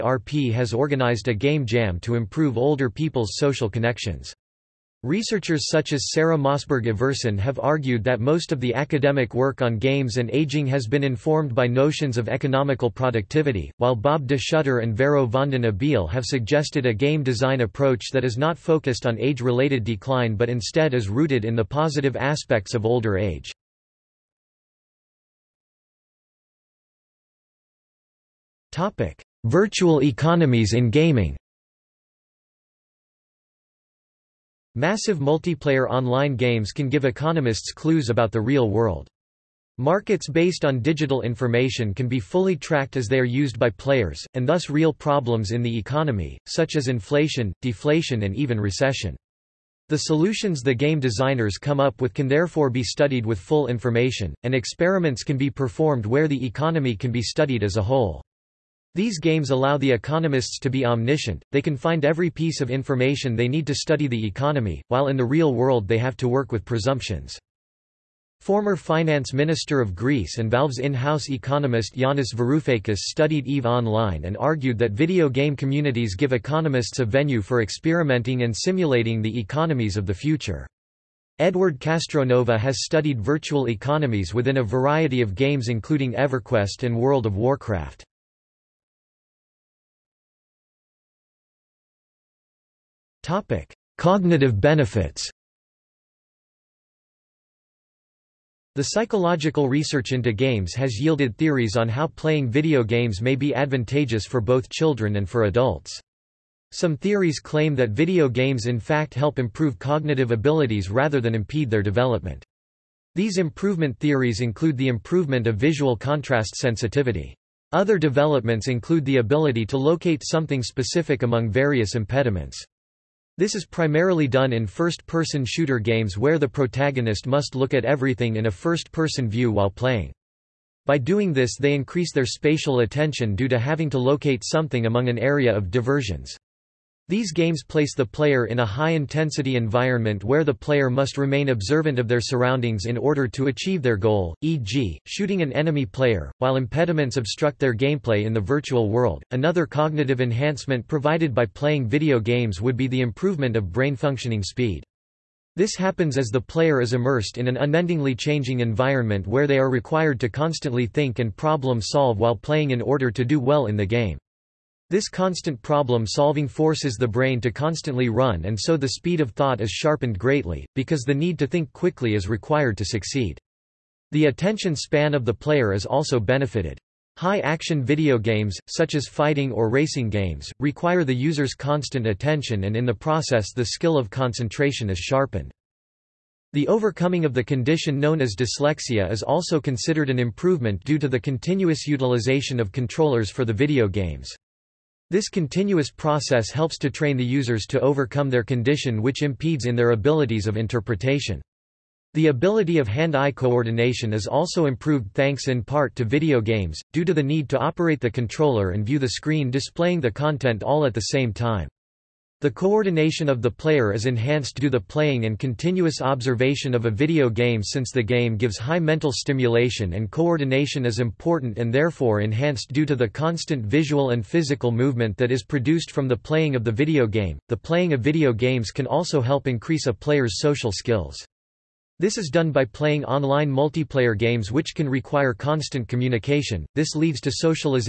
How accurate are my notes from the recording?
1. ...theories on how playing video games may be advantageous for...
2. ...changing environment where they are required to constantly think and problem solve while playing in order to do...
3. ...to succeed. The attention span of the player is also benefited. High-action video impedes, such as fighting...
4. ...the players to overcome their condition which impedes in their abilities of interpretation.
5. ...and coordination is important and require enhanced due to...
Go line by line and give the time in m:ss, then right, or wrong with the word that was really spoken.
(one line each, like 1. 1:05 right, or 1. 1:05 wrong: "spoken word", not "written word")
1. 1:41 right
2. 2:38 right
3. 2:52 wrong: "games", not "impedes"
4. 3:17 wrong: "users", not "players"
5. 3:39 wrong: "therefore", not "require".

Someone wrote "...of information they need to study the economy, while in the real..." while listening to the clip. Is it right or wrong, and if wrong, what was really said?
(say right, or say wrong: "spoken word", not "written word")
right.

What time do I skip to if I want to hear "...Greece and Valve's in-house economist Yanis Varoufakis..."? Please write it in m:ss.
1:09.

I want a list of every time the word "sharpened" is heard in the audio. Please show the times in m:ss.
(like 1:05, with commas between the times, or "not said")
2:49, 3:05.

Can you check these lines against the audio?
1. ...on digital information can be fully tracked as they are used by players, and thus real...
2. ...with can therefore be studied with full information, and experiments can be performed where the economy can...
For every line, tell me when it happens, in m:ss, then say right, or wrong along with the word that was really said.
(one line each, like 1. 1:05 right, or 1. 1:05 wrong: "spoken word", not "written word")
1. 0:40 right
2. 0:52 right.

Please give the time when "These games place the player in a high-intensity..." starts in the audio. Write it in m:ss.
2:17.